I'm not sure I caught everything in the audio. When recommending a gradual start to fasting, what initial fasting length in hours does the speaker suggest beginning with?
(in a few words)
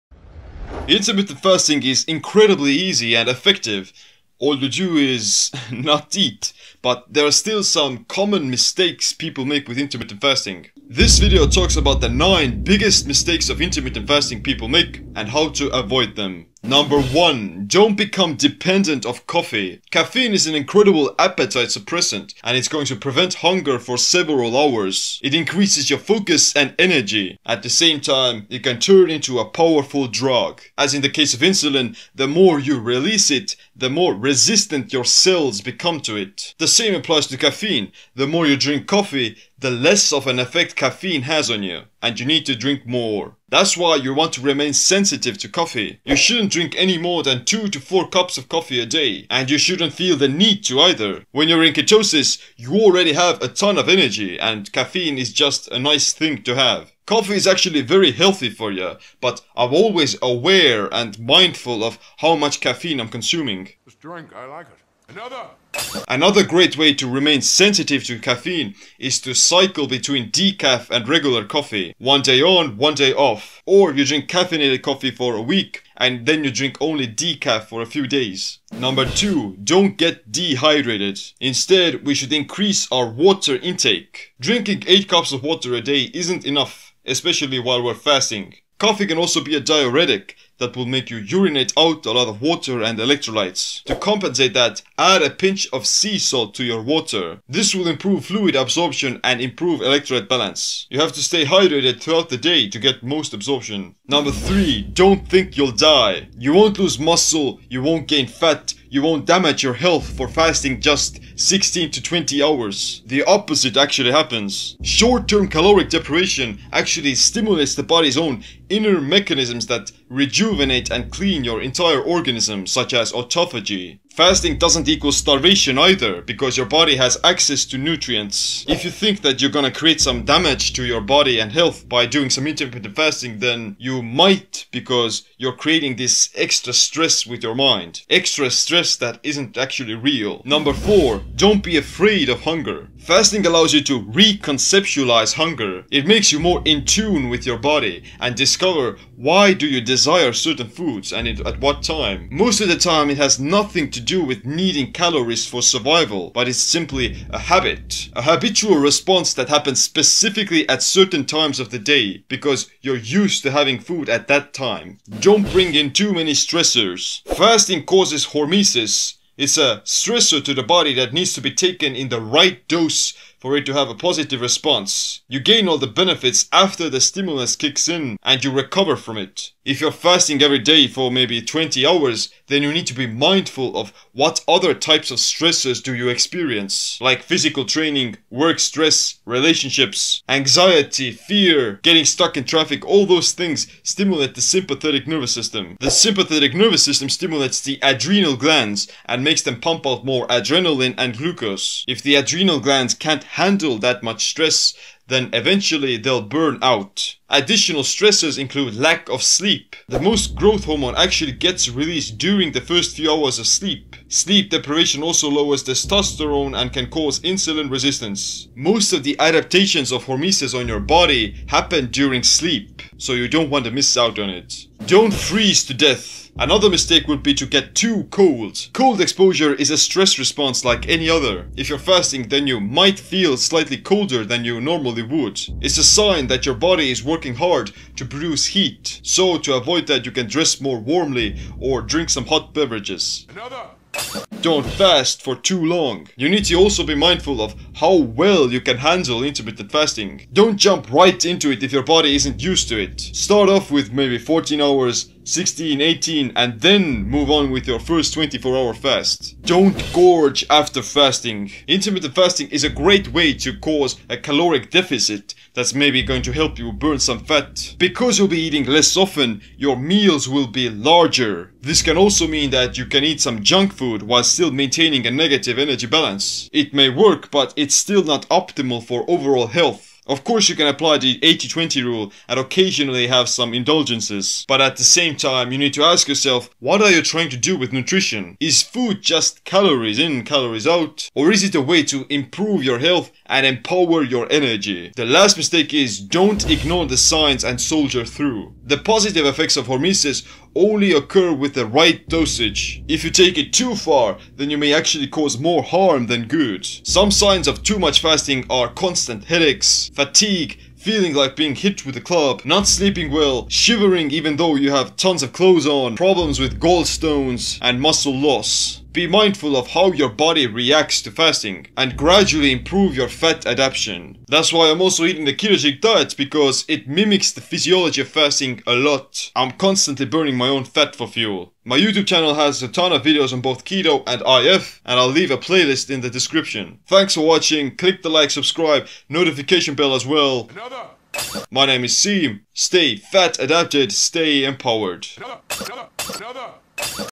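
14 hours.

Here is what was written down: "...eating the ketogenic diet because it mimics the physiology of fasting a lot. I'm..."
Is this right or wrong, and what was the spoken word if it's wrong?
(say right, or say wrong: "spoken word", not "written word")
right.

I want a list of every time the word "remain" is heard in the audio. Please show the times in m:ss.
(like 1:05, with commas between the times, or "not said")
0:44, 1:07.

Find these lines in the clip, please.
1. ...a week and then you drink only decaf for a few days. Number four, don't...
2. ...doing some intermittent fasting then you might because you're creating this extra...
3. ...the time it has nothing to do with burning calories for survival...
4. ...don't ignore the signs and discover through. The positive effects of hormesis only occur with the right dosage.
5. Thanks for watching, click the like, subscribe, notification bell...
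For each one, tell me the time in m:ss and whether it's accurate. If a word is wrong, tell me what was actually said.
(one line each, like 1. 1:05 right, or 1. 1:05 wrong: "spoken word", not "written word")
1. 1:15 wrong: "two", not "four"
2. 2:12 right
3. 2:32 wrong: "needing", not "burning"
4. 4:55 wrong: "soldier", not "discover"
5. 5:36 right.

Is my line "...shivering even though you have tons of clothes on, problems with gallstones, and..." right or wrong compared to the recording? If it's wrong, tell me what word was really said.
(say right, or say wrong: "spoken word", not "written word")
right.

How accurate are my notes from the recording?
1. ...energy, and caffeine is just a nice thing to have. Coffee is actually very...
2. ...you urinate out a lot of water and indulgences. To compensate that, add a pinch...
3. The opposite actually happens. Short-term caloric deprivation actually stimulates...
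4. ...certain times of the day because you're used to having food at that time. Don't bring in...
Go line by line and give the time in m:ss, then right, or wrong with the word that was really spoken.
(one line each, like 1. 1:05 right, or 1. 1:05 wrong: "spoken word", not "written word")
1. 0:53 right
2. 1:31 wrong: "electrolytes", not "indulgences"
3. 1:53 right
4. 2:40 right.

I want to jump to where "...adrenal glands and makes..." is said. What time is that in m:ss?
3:17.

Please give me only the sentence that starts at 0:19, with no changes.
Caffeine is an incredible appetite suppressant and it's going to prevent hunger for several hours.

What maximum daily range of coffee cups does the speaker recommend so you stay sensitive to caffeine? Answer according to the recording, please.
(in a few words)
2 to 4 cups.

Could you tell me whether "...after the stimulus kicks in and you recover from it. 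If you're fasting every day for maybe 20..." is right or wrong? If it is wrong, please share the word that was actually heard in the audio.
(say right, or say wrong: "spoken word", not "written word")
right.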